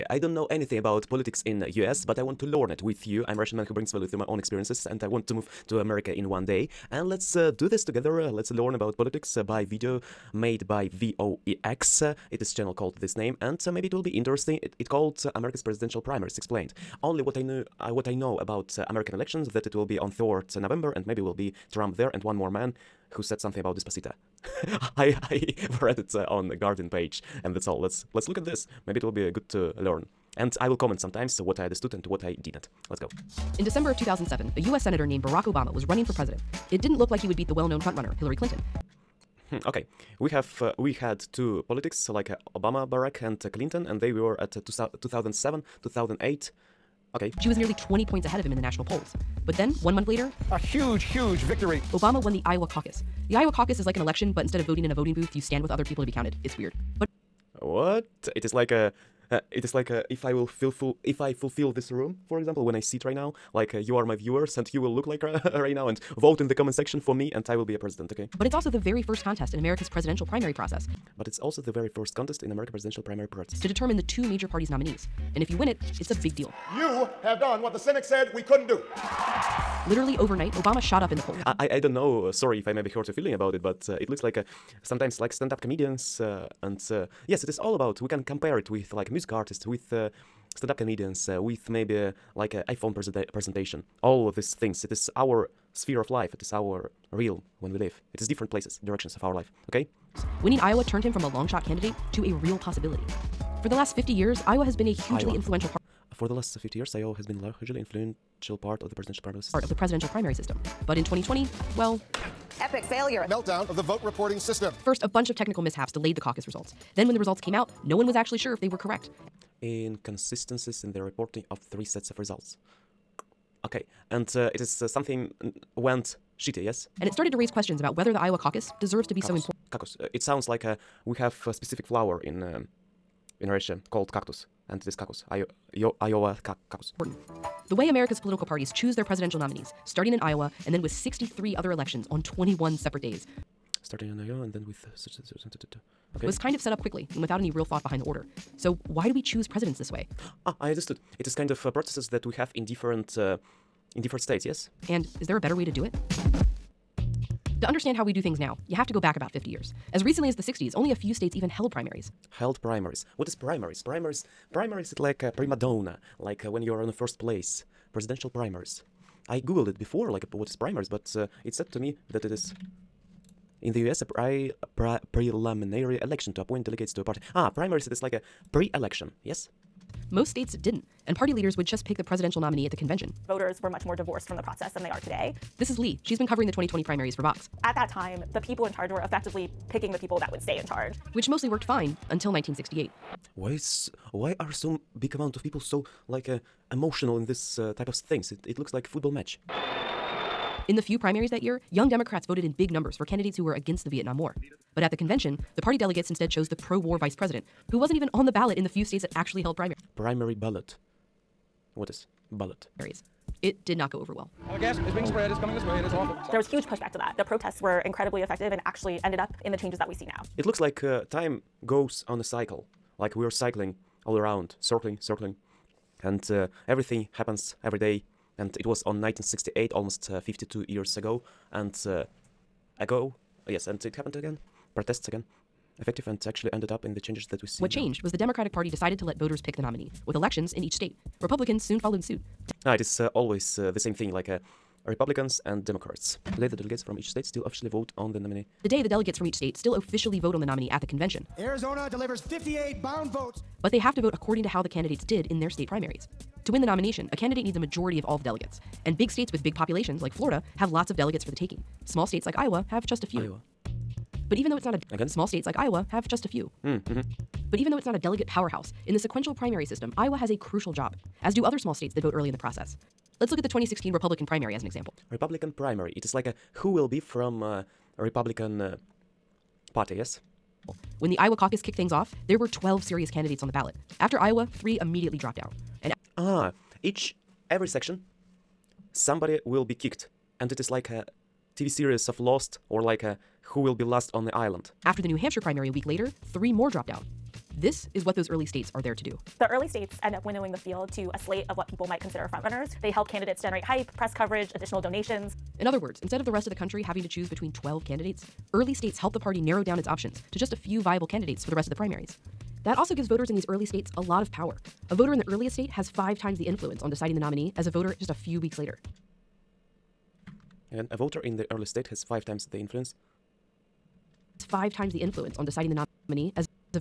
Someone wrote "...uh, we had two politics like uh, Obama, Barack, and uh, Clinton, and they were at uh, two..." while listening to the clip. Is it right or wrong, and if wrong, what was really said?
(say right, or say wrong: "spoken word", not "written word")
right.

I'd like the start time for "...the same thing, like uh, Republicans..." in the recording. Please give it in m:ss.
4:03.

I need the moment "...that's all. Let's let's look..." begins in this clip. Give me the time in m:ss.
0:27.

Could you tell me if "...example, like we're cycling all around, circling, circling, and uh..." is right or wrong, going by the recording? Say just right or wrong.
wrong.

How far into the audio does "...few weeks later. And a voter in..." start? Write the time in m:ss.
5:18.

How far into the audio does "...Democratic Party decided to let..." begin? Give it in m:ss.
3:58.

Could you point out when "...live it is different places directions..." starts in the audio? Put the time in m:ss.
1:37.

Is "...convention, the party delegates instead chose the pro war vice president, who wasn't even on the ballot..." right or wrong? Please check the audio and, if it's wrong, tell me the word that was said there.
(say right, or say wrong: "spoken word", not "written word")
right.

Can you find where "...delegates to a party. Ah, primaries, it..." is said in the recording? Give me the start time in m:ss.
2:56.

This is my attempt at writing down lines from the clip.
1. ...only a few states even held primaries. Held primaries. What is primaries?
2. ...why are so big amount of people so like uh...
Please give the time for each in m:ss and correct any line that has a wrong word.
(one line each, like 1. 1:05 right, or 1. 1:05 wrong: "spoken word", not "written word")
1. 2:40 right
2. 3:14 right.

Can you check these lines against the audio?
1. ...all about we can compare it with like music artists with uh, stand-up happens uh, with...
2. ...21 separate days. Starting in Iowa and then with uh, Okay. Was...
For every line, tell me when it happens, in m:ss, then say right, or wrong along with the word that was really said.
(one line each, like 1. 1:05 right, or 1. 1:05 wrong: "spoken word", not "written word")
1. 1:27 wrong: "comedians", not "happens"
2. 2:22 right.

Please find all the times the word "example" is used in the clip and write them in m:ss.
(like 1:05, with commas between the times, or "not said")
1:02, 4:34.